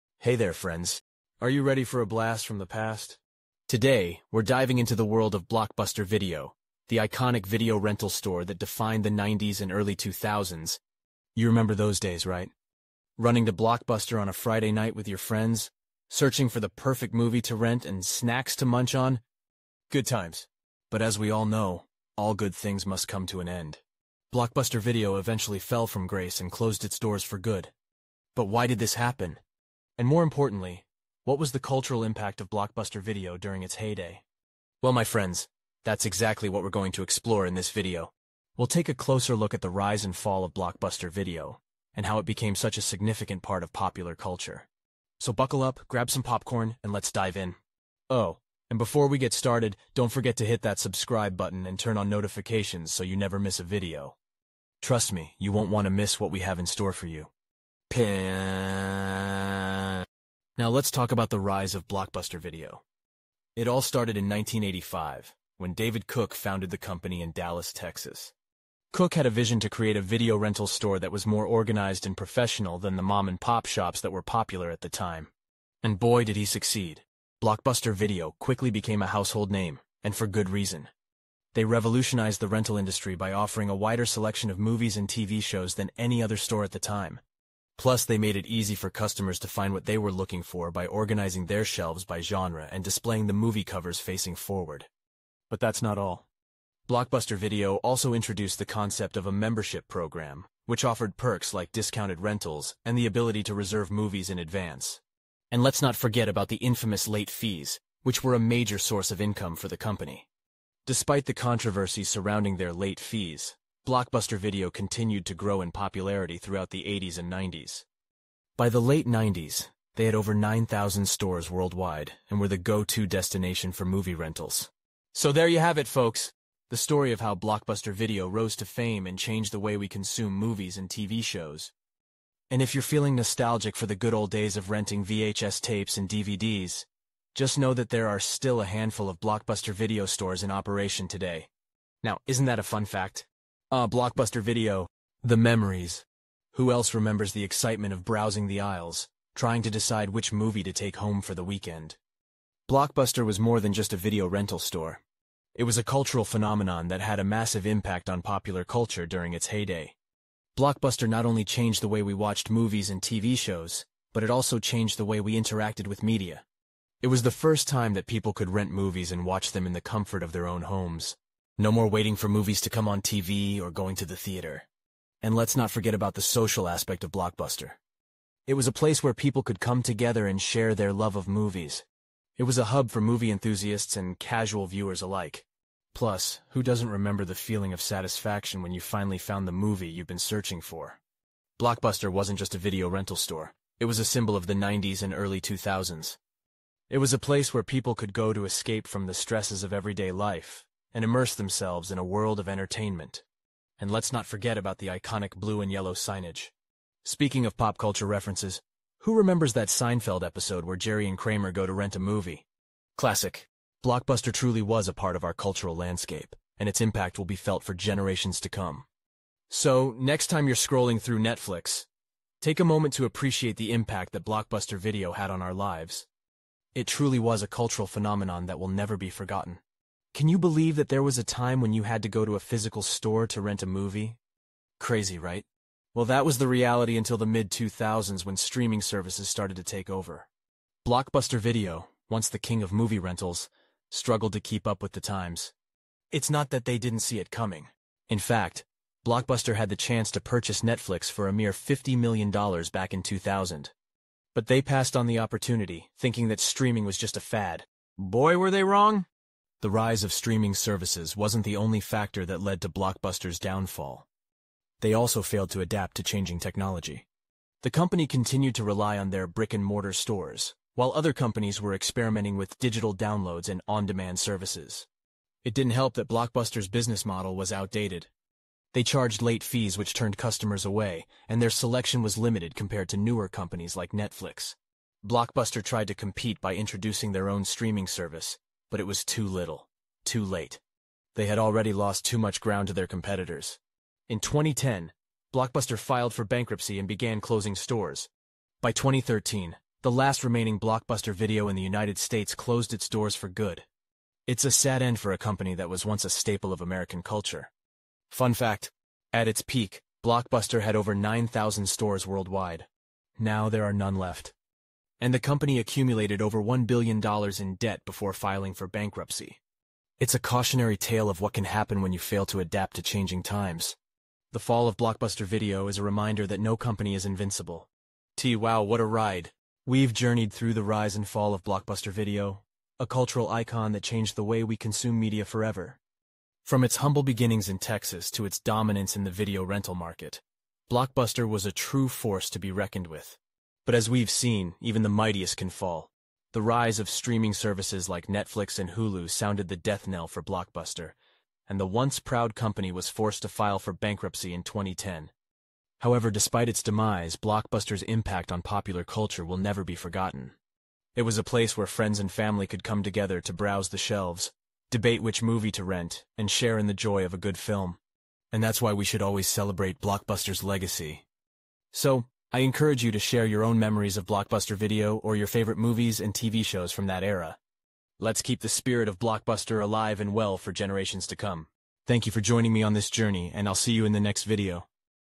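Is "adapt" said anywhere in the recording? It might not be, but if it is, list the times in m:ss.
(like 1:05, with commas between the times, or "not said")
4:25, 5:22.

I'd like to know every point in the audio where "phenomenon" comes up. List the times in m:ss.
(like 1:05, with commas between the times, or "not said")
2:36, 3:47.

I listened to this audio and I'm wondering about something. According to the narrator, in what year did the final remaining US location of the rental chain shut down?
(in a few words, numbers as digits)
2013.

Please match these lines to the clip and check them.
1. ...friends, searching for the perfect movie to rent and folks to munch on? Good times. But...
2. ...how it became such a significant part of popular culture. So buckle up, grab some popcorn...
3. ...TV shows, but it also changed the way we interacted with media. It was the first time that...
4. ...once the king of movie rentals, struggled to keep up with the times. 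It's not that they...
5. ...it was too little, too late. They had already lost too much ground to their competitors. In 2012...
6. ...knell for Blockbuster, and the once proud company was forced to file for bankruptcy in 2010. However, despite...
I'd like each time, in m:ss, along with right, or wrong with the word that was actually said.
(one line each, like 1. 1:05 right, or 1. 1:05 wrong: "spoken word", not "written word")
1. 0:15 wrong: "snacks", not "folks"
2. 0:42 right
3. 2:43 right
4. 4:02 right
5. 4:48 wrong: "2010", not "2012"
6. 5:49 right.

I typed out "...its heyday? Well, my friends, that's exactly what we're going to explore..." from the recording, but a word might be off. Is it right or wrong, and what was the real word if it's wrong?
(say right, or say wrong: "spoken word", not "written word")
right.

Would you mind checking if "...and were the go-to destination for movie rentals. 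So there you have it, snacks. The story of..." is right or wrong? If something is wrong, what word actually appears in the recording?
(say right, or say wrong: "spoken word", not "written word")
wrong: "folks", not "snacks".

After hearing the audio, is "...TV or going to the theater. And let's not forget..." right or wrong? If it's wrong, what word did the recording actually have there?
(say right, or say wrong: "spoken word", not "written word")
right.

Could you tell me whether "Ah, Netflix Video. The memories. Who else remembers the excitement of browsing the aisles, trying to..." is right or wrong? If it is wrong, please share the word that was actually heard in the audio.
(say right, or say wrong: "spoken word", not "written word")
wrong: "Blockbuster", not "Netflix".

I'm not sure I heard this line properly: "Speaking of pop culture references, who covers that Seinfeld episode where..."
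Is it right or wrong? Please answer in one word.
wrong.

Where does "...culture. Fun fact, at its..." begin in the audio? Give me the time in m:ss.
5:07.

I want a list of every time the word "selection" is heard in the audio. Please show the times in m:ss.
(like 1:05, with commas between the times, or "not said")
1:24, 4:41.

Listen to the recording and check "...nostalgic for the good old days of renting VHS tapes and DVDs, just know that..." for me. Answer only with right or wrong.
right.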